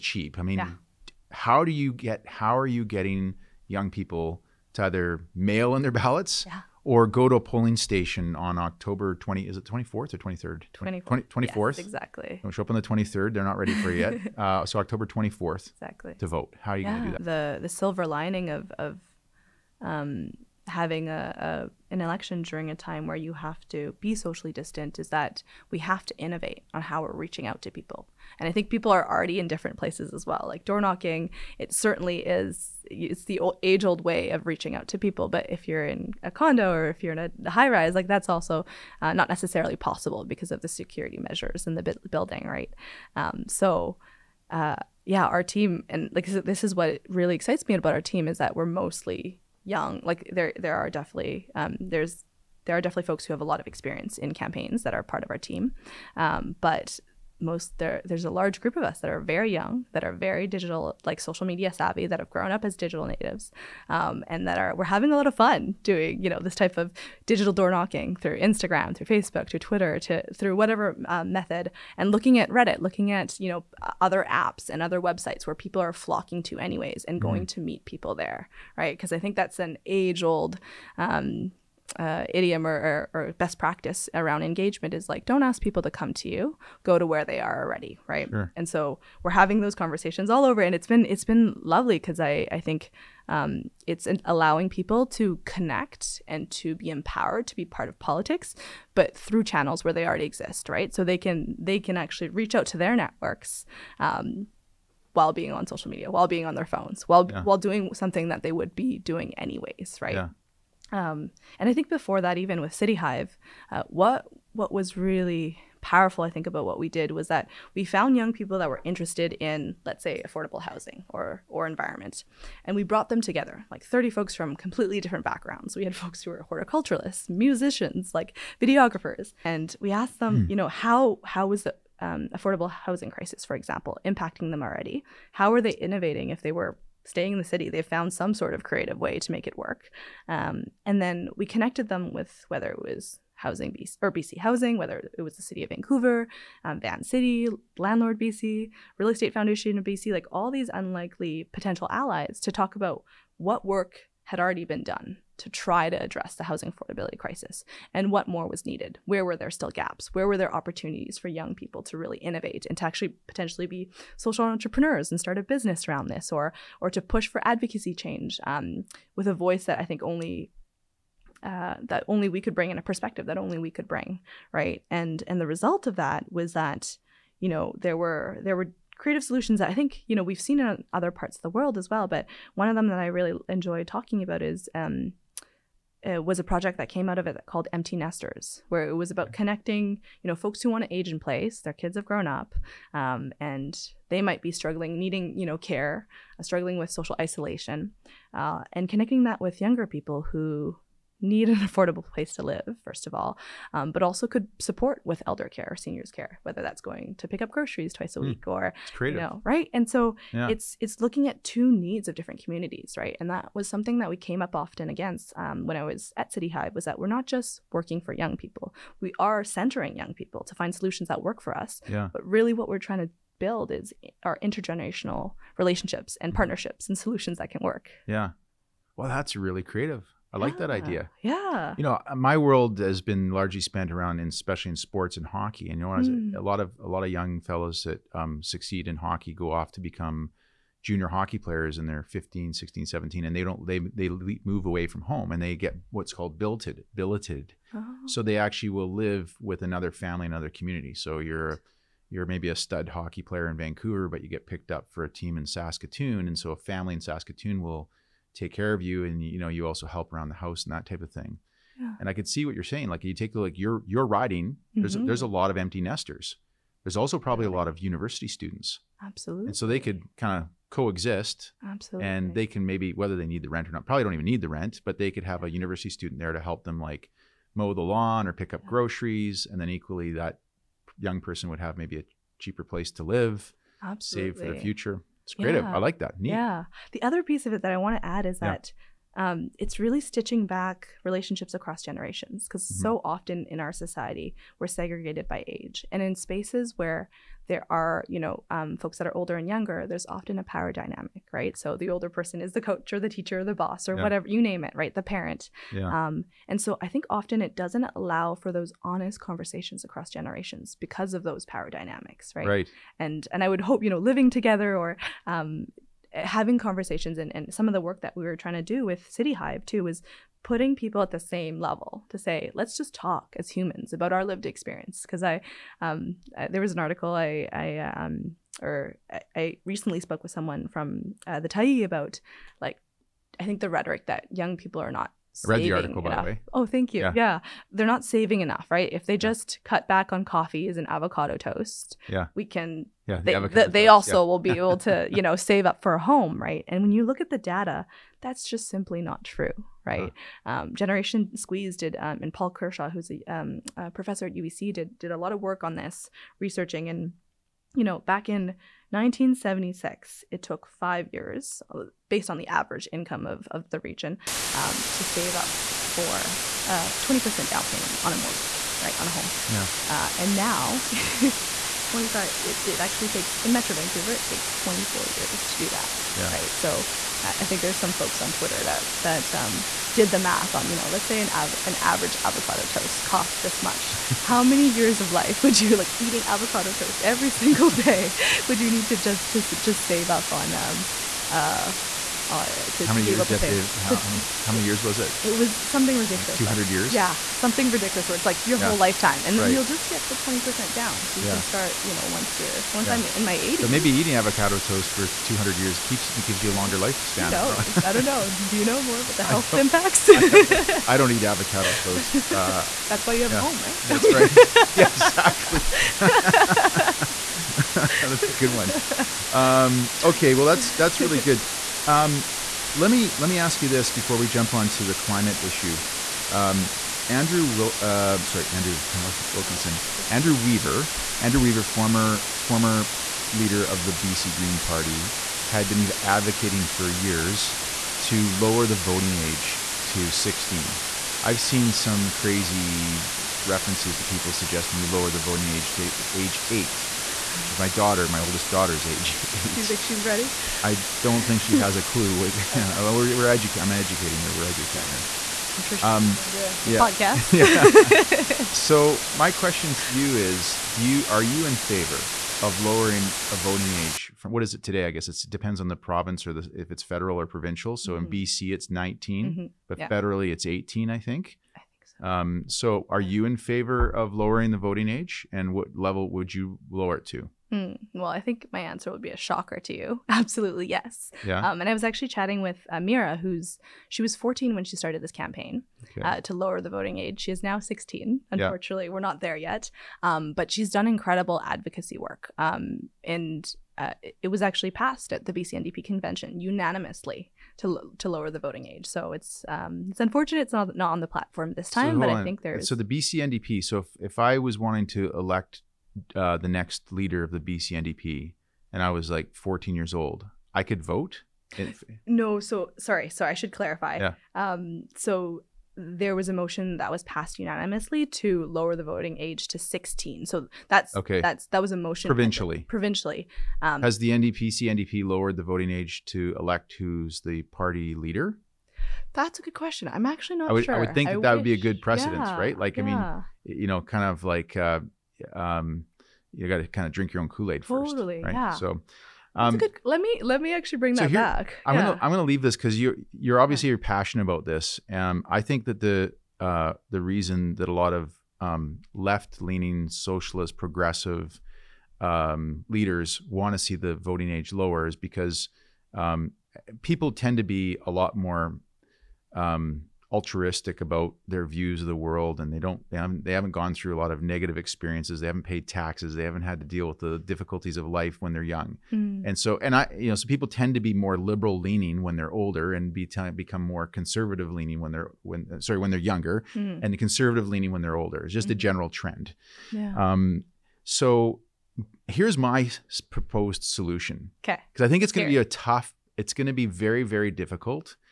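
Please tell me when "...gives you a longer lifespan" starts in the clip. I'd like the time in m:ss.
6:46.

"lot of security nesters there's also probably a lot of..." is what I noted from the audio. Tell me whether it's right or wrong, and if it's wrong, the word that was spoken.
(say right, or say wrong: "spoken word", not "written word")
wrong: "empty", not "security".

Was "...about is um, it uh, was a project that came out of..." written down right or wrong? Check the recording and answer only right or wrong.
right.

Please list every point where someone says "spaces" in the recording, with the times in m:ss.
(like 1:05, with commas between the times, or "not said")
4:56.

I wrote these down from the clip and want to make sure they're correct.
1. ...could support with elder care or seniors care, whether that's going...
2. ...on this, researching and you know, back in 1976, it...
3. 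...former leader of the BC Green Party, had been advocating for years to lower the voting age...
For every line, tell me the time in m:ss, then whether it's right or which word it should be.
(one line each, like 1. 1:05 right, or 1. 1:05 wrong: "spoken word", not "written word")
1. 3:24 right
2. 5:55 right
3. 7:12 right.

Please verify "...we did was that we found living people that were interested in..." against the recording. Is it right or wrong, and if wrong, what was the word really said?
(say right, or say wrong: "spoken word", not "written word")
wrong: "young", not "living".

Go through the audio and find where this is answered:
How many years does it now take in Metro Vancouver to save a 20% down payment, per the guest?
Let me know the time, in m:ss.
6:14.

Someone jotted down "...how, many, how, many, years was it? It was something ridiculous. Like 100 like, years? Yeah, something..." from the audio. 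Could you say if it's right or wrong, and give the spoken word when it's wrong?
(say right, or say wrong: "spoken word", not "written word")
wrong: "200", not "100".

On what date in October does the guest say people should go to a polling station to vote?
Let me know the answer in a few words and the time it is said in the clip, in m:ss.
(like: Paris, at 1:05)
October 24th, at 0:14.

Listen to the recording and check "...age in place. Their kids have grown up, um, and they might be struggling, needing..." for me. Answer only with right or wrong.
right.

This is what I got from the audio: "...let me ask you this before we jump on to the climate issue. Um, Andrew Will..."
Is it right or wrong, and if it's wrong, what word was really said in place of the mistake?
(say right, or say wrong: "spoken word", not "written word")
right.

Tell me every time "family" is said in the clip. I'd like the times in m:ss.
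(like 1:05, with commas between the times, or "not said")
4:09, 4:16.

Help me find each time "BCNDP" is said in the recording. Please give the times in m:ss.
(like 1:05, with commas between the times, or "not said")
8:15, 8:22, 8:27.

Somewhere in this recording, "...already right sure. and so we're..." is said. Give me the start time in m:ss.
1:27.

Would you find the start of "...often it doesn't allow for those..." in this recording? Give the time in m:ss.
5:07.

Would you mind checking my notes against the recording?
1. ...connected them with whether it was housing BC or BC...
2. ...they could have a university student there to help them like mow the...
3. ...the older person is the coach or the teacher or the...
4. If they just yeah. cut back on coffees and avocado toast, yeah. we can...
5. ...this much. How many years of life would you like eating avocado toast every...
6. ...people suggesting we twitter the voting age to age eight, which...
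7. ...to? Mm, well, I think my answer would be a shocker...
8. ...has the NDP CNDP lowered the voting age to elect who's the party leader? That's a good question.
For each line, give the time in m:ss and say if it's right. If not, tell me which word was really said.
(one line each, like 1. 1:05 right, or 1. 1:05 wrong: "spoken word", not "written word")
1. 2:21 right
2. 4:34 right
3. 5:01 right
4. 5:38 right
5. 6:23 right
6. 7:24 wrong: "lower", not "twitter"
7. 7:57 right
8. 8:43 right.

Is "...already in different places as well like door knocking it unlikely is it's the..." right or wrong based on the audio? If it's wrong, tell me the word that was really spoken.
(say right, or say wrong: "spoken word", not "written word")
wrong: "certainly", not "unlikely".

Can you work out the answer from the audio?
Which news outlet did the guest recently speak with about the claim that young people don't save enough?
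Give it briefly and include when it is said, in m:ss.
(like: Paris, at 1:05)
The Tyee, at 5:31.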